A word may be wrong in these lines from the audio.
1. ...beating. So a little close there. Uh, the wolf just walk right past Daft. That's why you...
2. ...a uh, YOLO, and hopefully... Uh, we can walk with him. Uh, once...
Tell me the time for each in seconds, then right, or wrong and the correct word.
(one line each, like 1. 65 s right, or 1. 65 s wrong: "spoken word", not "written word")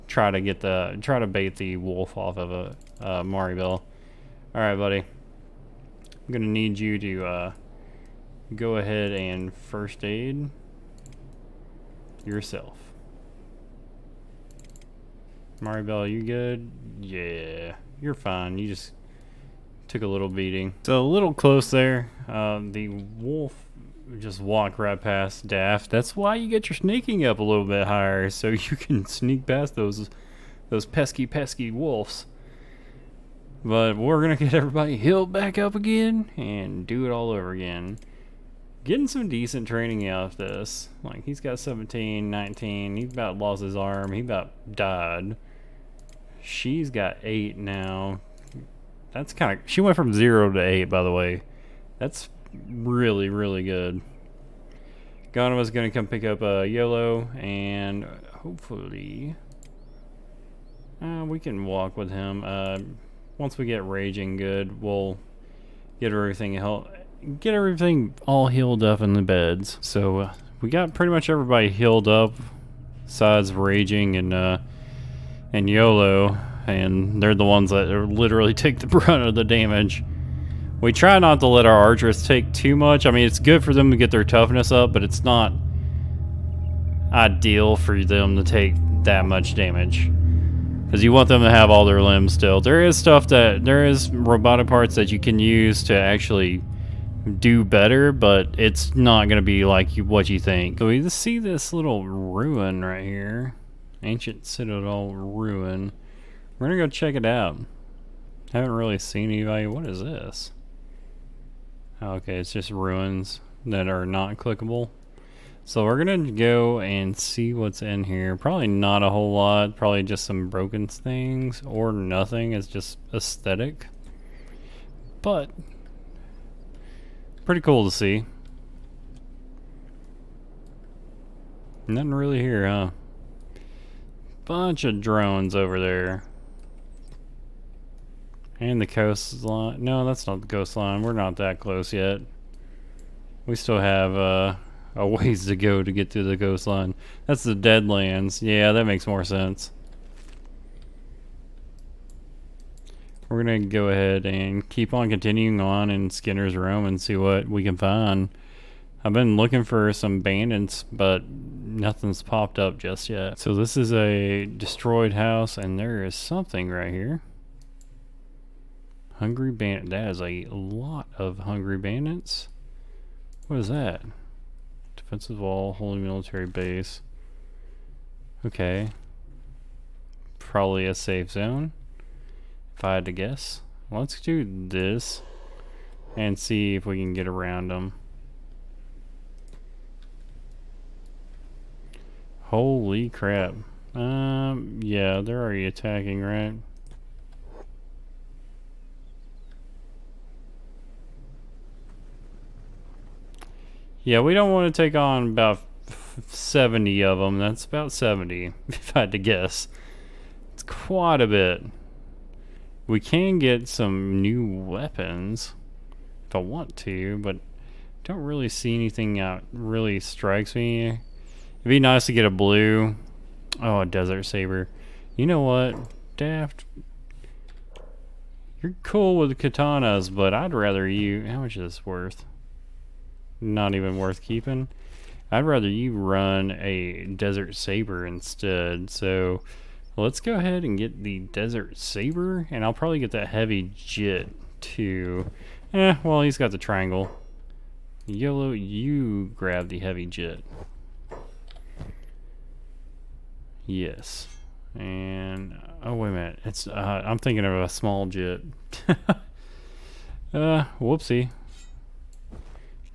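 1. 20 s right
2. 56 s right.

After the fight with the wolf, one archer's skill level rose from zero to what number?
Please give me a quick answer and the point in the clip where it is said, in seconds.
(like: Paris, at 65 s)
8, at 49 s.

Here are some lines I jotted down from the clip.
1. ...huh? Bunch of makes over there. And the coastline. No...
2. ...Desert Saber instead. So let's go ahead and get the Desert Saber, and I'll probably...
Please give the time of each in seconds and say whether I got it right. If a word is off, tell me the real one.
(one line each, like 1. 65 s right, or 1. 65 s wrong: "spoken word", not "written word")
1. 132 s wrong: "drones", not "makes"
2. 237 s right.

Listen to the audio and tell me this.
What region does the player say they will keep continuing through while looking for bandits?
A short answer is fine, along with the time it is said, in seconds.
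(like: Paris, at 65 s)
Skinner's Roam, at 156 s.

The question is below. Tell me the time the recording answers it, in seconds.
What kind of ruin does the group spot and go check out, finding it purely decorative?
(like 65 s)
104 s.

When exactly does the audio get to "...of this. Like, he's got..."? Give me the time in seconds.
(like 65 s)
40 s.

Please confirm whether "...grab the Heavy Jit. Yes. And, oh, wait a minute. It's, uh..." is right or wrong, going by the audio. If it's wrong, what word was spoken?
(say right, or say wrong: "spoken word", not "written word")
right.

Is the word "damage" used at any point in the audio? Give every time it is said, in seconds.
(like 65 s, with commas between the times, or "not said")
79 s, 89 s.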